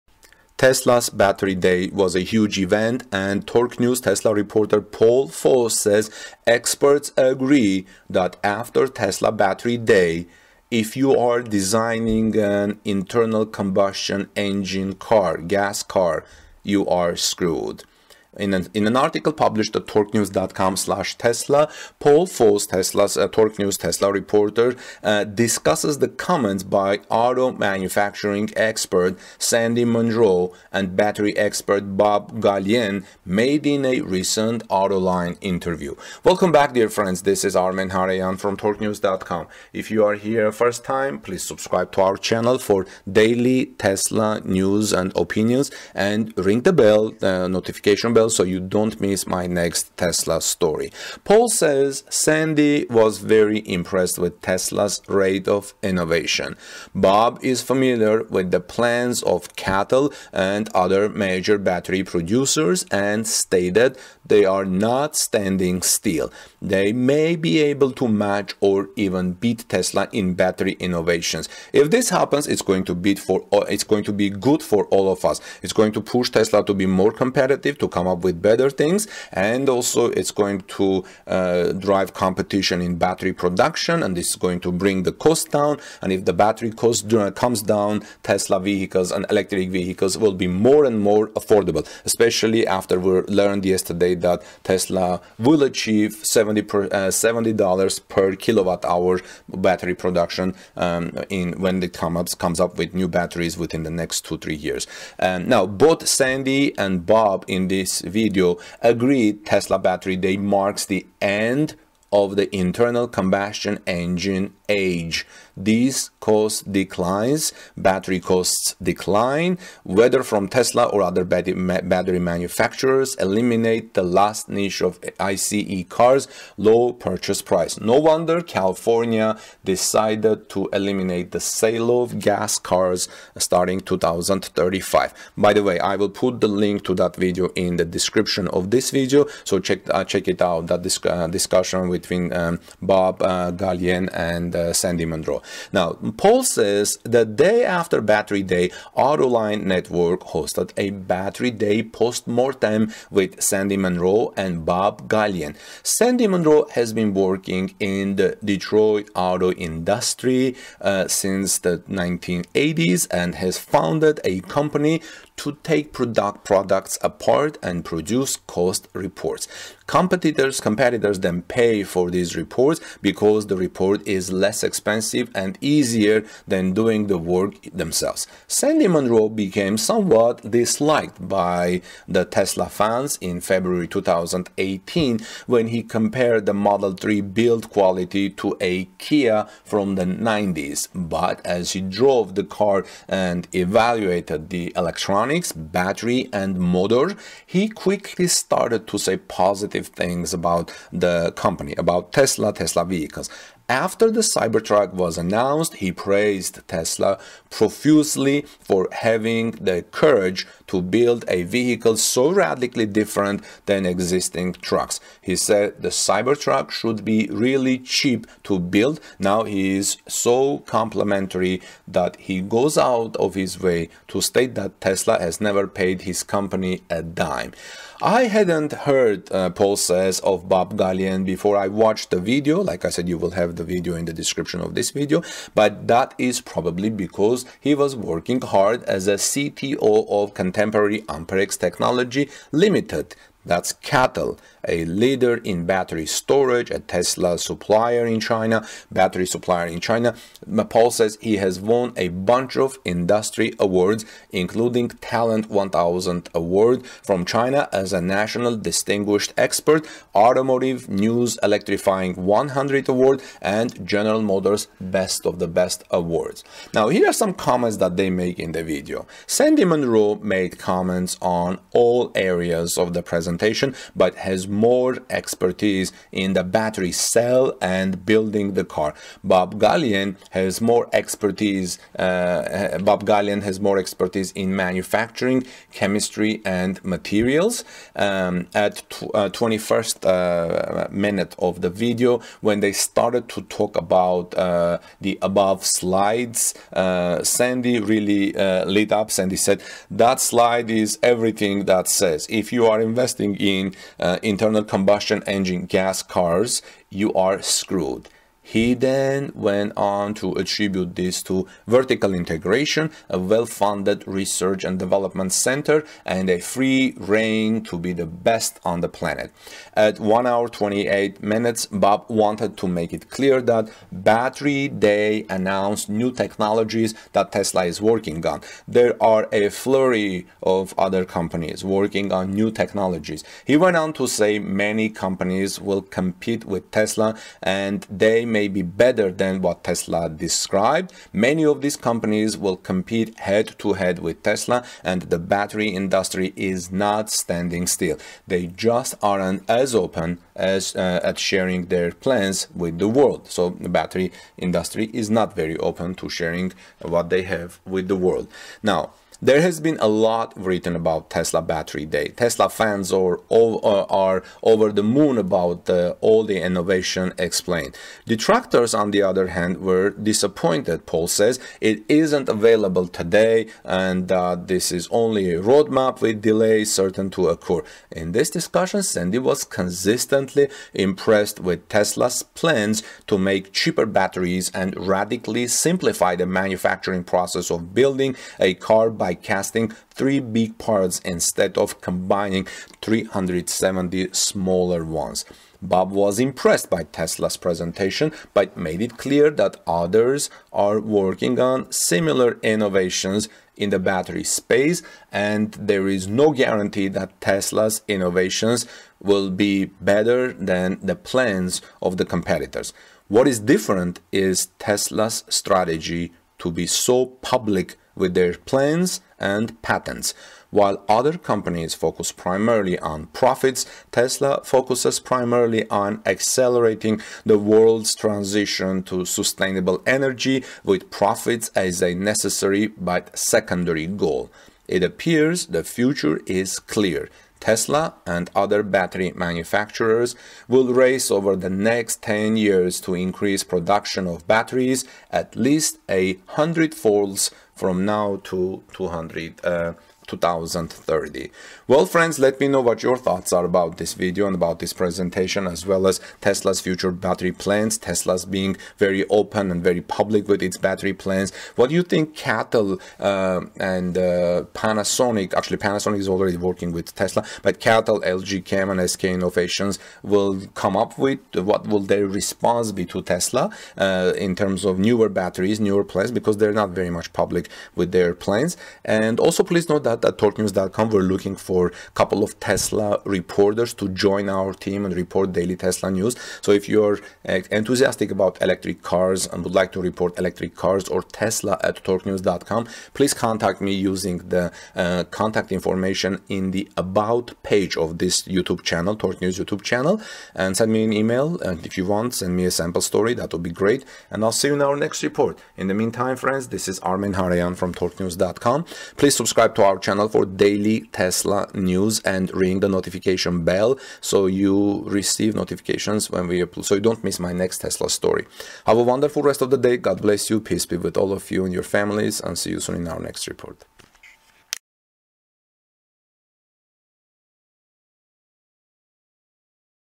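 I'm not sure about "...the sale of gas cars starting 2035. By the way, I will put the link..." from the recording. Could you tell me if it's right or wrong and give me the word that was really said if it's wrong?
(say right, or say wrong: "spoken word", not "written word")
right.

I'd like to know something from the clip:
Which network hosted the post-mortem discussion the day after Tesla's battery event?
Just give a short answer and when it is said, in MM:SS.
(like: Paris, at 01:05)
Autoline Network, at 02:28.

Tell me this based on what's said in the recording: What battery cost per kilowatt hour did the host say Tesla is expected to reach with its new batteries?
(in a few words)
$70.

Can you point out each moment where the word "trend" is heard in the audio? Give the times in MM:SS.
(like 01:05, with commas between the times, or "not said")
not said.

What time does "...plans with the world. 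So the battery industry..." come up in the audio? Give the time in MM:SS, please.
05:52.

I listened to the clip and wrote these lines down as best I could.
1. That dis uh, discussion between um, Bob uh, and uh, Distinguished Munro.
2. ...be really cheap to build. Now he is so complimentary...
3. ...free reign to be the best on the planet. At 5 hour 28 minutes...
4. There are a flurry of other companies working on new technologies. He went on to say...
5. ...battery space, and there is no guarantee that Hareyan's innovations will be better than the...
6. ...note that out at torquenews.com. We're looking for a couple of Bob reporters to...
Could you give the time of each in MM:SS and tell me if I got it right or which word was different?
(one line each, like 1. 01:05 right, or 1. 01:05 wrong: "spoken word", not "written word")
1. 02:20 wrong: "Sandy", not "Distinguished"
2. 03:37 right
3. 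05:16 wrong: "1", not "5"
4. 05:28 right
5. 06:43 wrong: "Tesla", not "Hareyan"
6. 07:59 wrong: "Tesla", not "Bob".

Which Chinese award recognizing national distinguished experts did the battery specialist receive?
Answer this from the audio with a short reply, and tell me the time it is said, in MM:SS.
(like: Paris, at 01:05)
Talent 1000 Award, at 04:14.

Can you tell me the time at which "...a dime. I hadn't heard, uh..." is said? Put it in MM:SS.
03:46.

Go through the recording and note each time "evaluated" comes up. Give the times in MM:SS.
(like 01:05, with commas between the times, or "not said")
03:13.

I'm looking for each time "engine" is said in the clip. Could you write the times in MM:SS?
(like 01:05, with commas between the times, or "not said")
00:14, 01:53, 05:05.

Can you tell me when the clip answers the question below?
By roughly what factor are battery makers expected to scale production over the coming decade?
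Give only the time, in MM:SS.
07:25.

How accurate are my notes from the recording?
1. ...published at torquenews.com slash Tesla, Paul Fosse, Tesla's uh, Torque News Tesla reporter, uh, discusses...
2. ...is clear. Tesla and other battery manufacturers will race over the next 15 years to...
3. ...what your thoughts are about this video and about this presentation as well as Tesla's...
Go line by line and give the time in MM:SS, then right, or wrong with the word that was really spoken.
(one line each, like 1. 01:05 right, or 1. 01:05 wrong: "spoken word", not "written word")
1. 00:19 right
2. 07:16 wrong: "10", not "15"
3. 07:32 right.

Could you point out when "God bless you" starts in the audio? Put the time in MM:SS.
08:39.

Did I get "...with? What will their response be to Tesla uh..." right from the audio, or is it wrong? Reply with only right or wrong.
right.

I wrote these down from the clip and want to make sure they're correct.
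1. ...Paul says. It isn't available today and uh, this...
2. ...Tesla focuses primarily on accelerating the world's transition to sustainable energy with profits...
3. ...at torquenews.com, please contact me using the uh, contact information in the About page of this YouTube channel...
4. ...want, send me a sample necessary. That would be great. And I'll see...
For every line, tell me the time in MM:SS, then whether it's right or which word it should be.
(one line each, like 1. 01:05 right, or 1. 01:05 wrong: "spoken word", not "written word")
1. 06:10 right
2. 07:03 right
3. 08:11 right
4. 08:21 wrong: "story", not "necessary".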